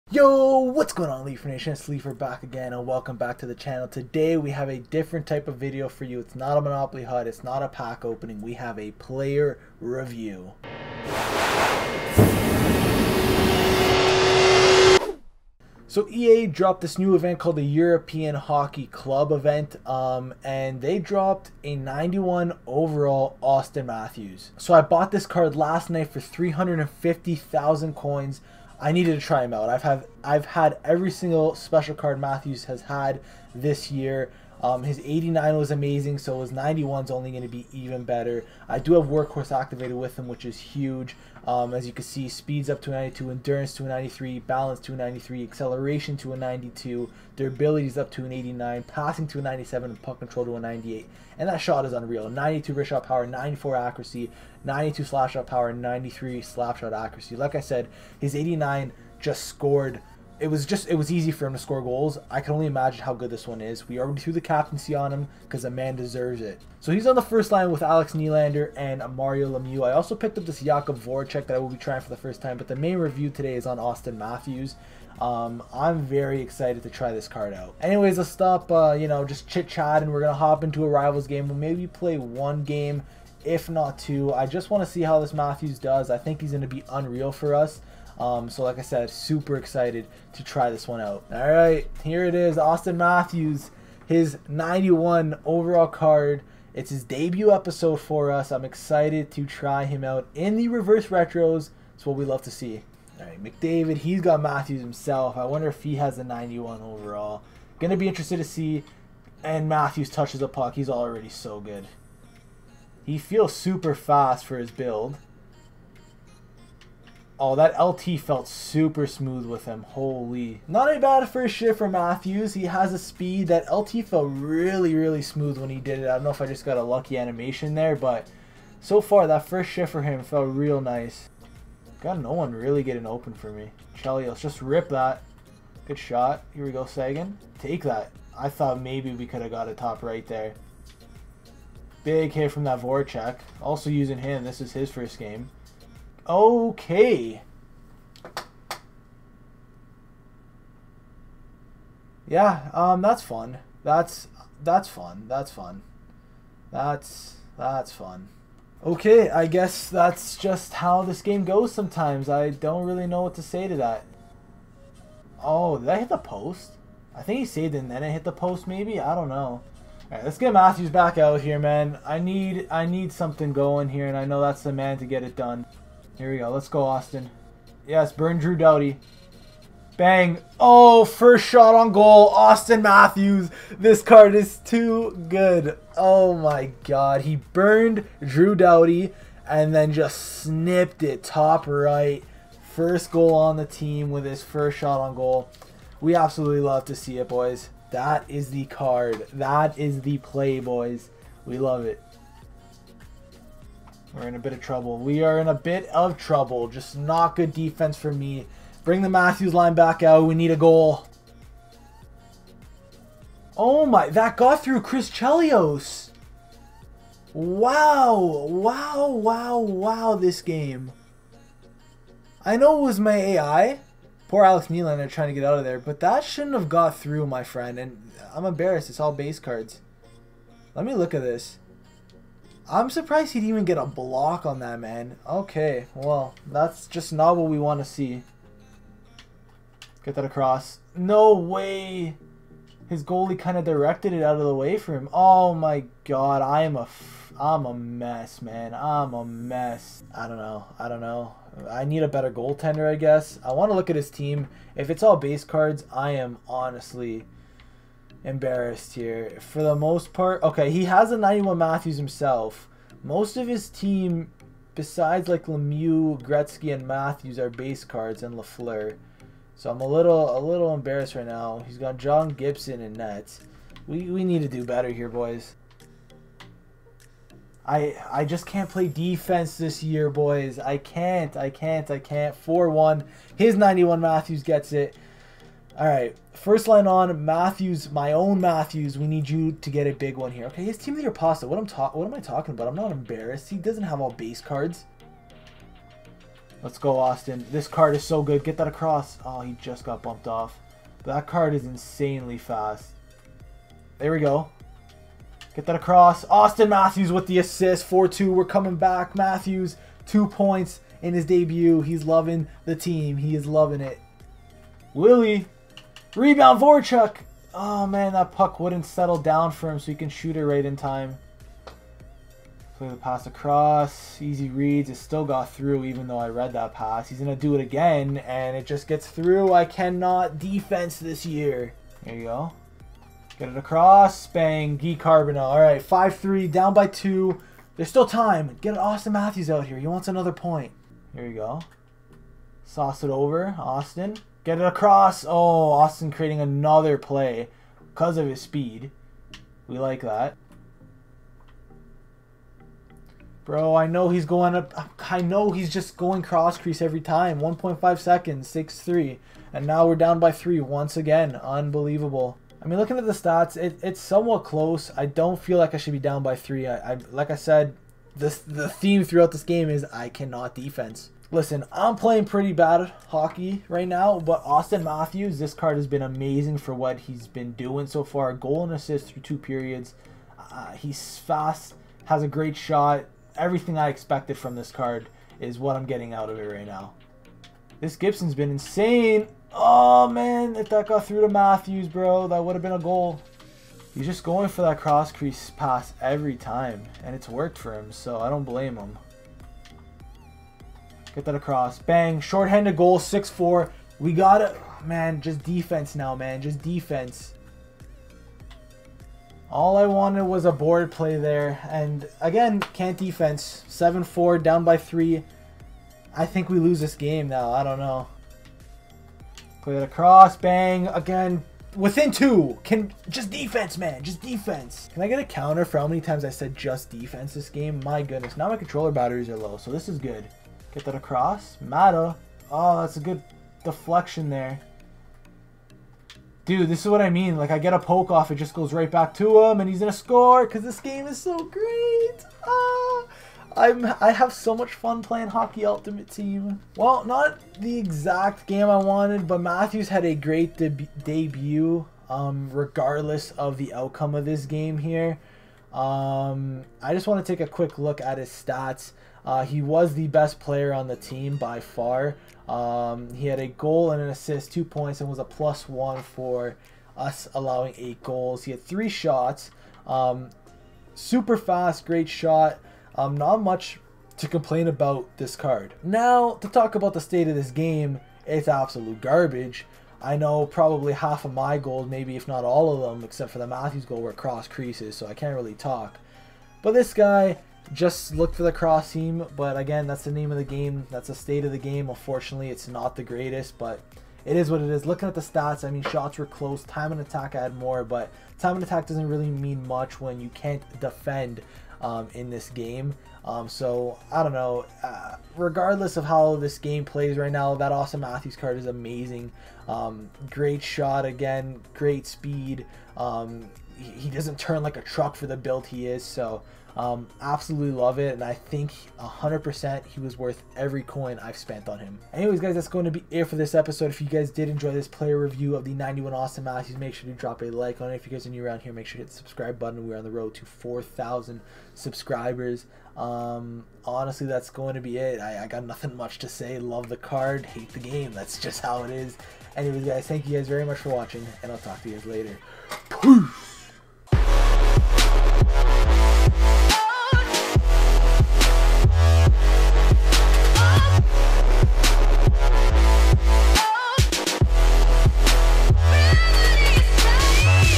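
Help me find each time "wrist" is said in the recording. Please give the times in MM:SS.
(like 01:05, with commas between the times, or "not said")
00:52.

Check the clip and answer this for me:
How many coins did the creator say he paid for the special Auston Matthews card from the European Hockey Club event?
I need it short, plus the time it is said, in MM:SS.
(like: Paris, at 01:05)
350,000, at 00:26.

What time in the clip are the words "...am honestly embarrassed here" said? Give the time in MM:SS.
04:16.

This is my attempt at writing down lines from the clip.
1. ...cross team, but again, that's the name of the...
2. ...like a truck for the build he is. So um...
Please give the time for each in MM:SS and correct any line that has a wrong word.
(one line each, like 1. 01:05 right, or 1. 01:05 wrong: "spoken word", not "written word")
1. 08:08 right
2. 08:34 right.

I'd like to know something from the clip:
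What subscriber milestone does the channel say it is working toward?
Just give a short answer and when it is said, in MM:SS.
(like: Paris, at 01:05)
4,000, at 08:50.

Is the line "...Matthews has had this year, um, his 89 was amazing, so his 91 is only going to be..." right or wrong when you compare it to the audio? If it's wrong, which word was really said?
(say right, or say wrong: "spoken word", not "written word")
right.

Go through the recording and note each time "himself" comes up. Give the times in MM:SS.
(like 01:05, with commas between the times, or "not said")
01:44, 04:21.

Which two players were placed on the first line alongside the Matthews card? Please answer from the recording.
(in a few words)
Alex Nylander and Mario Lemieux.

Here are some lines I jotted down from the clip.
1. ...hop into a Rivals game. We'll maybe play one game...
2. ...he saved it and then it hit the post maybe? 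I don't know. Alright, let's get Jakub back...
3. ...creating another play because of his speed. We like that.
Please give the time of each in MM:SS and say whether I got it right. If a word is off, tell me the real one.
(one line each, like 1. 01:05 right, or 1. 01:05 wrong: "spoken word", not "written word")
1. 01:20 right
2. 02:47 wrong: "Matthews", not "Jakub"
3. 05:46 right.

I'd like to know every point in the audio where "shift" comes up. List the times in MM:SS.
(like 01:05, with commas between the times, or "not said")
02:01, 02:09.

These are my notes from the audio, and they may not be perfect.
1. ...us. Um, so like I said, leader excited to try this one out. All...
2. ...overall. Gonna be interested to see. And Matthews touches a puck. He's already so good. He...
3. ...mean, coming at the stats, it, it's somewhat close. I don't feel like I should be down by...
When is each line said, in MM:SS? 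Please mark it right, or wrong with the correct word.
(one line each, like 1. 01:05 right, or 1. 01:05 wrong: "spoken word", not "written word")
1. 01:27 wrong: "super", not "leader"
2. 01:46 right
3. 06:02 wrong: "looking", not "coming".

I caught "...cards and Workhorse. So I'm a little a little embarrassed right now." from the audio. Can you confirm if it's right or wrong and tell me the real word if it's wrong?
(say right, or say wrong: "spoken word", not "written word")
wrong: "Lafleur", not "Workhorse".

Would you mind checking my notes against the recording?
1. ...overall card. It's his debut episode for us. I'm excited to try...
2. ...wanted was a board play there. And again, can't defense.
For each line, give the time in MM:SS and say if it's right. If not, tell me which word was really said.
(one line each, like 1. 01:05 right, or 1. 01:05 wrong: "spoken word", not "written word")
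1. 01:35 right
2. 06:49 right.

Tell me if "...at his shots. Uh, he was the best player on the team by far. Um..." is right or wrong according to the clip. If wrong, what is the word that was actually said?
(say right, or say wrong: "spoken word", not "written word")
wrong: "stats", not "shots".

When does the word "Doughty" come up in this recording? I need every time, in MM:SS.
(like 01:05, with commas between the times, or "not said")
02:58, 03:08.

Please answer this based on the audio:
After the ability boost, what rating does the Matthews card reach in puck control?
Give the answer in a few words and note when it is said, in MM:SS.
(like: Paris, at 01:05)
98, at 00:50.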